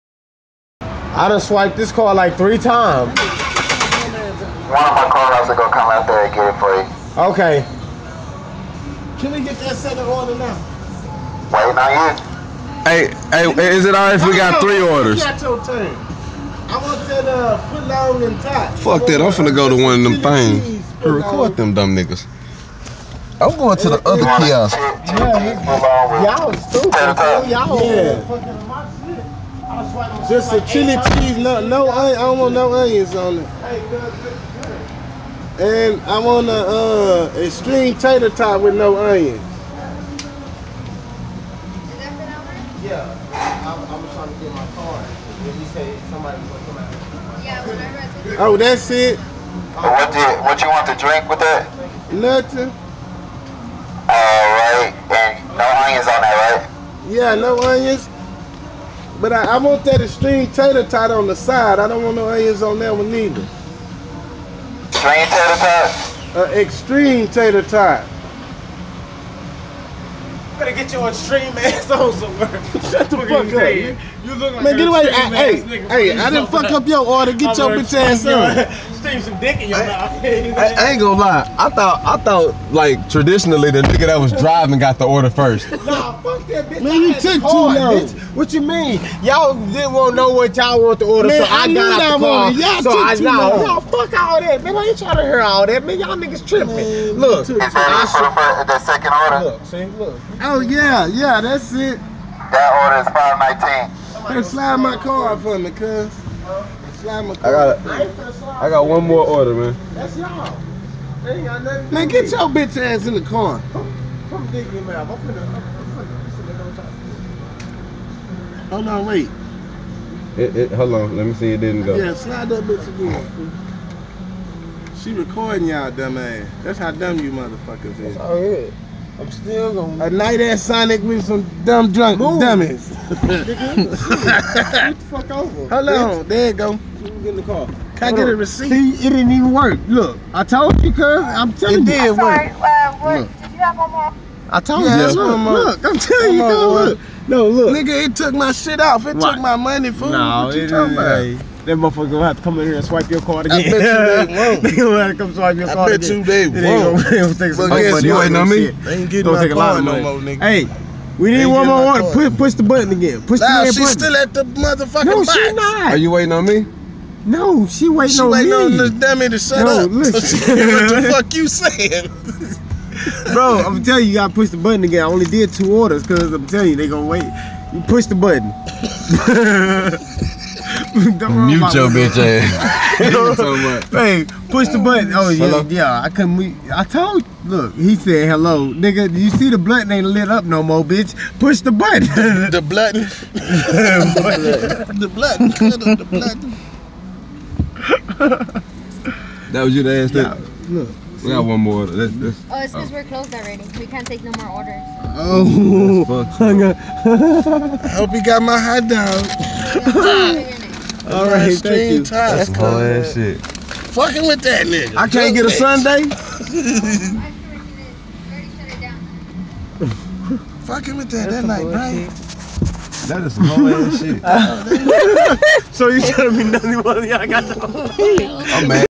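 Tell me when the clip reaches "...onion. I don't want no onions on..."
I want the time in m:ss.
0:31.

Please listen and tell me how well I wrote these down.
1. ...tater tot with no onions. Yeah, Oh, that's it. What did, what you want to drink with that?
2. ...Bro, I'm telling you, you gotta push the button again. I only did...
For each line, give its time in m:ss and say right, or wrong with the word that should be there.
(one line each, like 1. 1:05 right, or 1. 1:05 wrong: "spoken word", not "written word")
1. 0:37 right
2. 2:53 right.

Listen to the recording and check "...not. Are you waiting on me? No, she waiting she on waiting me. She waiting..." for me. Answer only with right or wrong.
right.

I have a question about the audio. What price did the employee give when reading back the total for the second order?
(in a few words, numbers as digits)
$5.19.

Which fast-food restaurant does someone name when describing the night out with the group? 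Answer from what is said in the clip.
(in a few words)
Sonic.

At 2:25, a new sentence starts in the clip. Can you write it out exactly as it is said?
Look, look, look, I'm telling you, on, look.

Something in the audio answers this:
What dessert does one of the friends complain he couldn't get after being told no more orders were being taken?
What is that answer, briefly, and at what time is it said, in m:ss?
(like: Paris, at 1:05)
sundae, at 3:35.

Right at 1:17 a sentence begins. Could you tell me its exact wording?
Get i your bitch ass on seen some dick in your I, mouth.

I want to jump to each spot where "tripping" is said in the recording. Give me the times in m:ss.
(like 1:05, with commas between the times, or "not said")
1:36.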